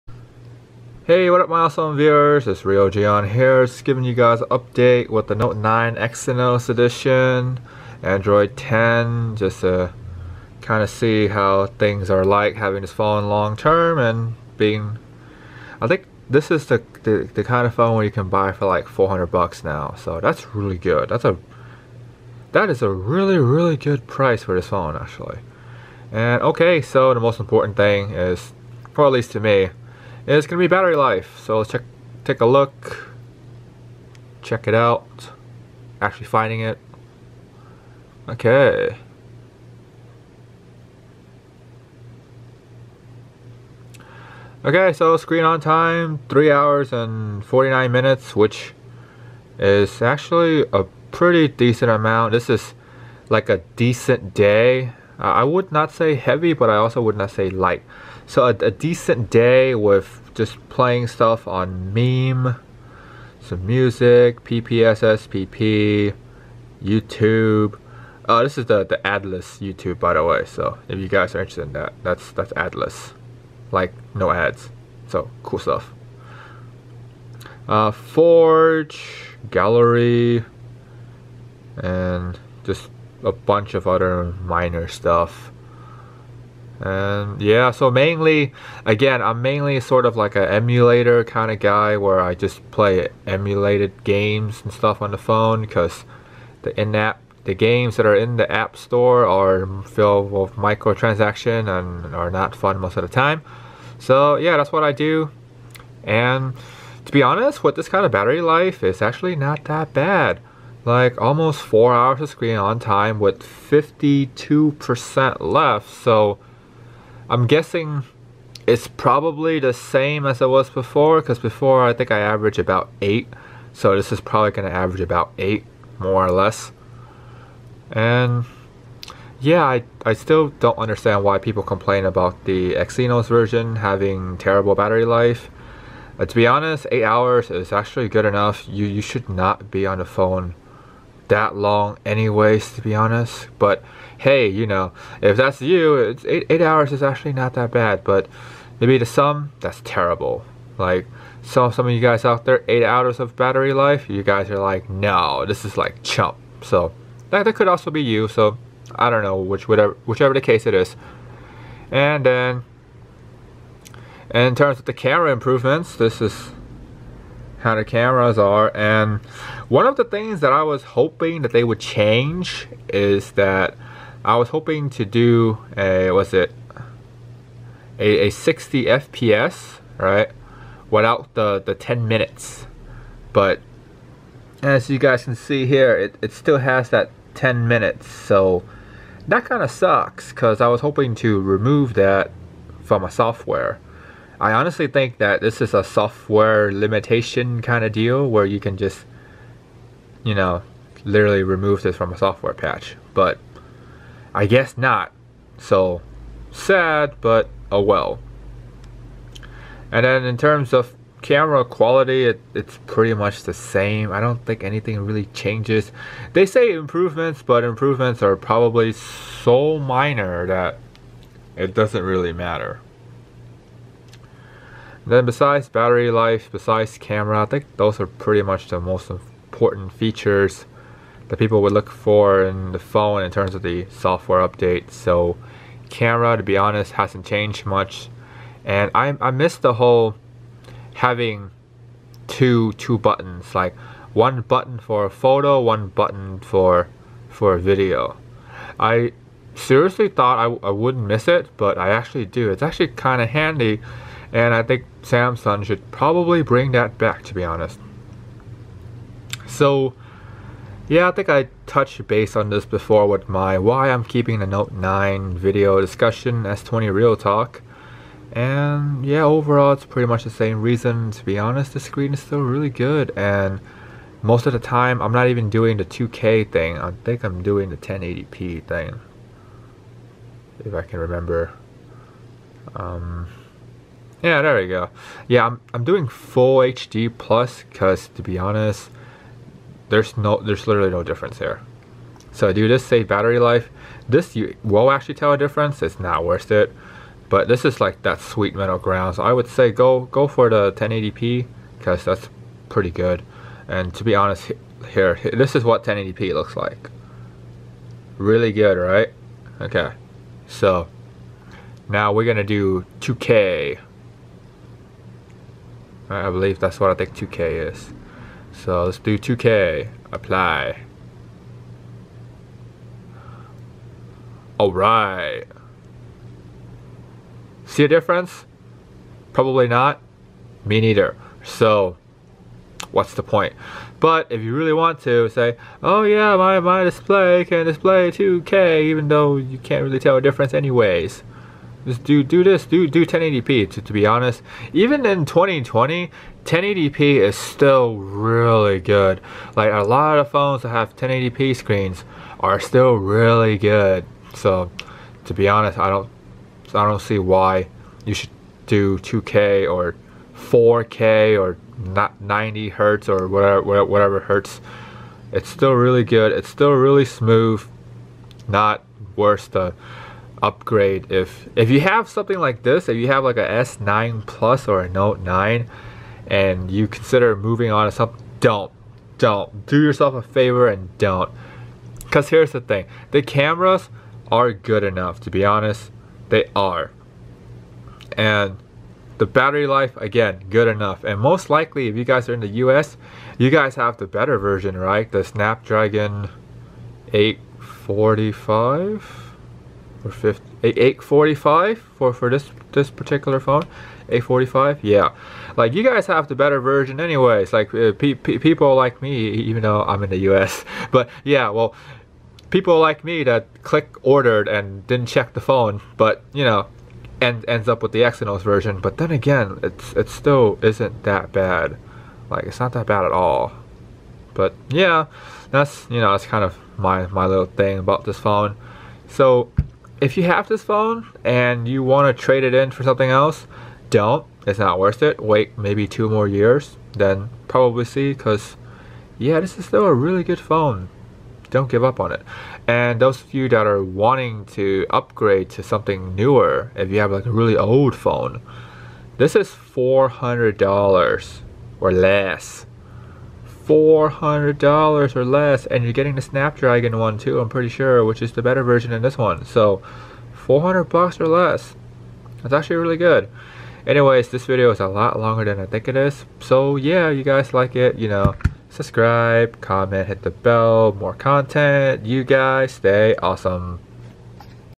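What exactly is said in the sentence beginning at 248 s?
I seriously thought I, I wouldn't miss it, but I actually do.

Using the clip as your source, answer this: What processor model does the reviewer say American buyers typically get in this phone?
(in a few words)
Snapdragon 845.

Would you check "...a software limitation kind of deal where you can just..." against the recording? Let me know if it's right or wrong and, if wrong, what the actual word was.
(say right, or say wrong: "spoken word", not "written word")
right.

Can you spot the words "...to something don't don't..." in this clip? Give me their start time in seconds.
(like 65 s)
377 s.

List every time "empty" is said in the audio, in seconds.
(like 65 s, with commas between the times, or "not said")
not said.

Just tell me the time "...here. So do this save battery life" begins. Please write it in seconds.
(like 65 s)
291 s.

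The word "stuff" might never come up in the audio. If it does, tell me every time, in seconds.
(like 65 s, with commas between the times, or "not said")
61 s, 75 s, 84 s, 94 s.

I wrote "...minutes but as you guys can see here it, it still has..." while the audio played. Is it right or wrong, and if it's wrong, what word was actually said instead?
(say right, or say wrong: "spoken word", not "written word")
right.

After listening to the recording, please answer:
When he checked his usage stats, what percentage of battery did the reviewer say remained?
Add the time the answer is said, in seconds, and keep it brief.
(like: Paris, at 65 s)
52%, at 113 s.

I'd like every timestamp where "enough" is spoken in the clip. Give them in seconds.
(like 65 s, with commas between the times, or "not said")
138 s, 384 s, 390 s.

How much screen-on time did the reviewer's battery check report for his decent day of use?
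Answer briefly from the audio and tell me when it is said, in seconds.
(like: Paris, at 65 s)
3 hours and 49 minutes, at 46 s.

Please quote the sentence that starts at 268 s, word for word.
And yeah, overall it's pretty much the same reason.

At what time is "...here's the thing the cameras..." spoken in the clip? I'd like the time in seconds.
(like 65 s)
382 s.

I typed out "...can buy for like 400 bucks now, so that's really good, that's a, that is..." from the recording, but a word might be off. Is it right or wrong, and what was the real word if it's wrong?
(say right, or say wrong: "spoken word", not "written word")
right.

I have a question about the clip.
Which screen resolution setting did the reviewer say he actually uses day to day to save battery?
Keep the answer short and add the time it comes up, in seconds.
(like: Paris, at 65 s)
Full HD plus, at 286 s.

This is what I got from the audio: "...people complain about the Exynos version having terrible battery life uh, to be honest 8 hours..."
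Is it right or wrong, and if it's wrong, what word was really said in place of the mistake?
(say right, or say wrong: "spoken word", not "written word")
right.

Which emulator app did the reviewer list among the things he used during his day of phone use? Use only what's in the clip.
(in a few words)
PPSSPP.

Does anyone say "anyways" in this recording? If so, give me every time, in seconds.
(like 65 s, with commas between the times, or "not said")
142 s, 340 s, 406 s, 463 s.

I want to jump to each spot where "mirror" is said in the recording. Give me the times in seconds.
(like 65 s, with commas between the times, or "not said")
not said.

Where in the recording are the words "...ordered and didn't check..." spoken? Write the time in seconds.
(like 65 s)
414 s.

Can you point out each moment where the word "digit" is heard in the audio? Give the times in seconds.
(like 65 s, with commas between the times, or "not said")
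not said.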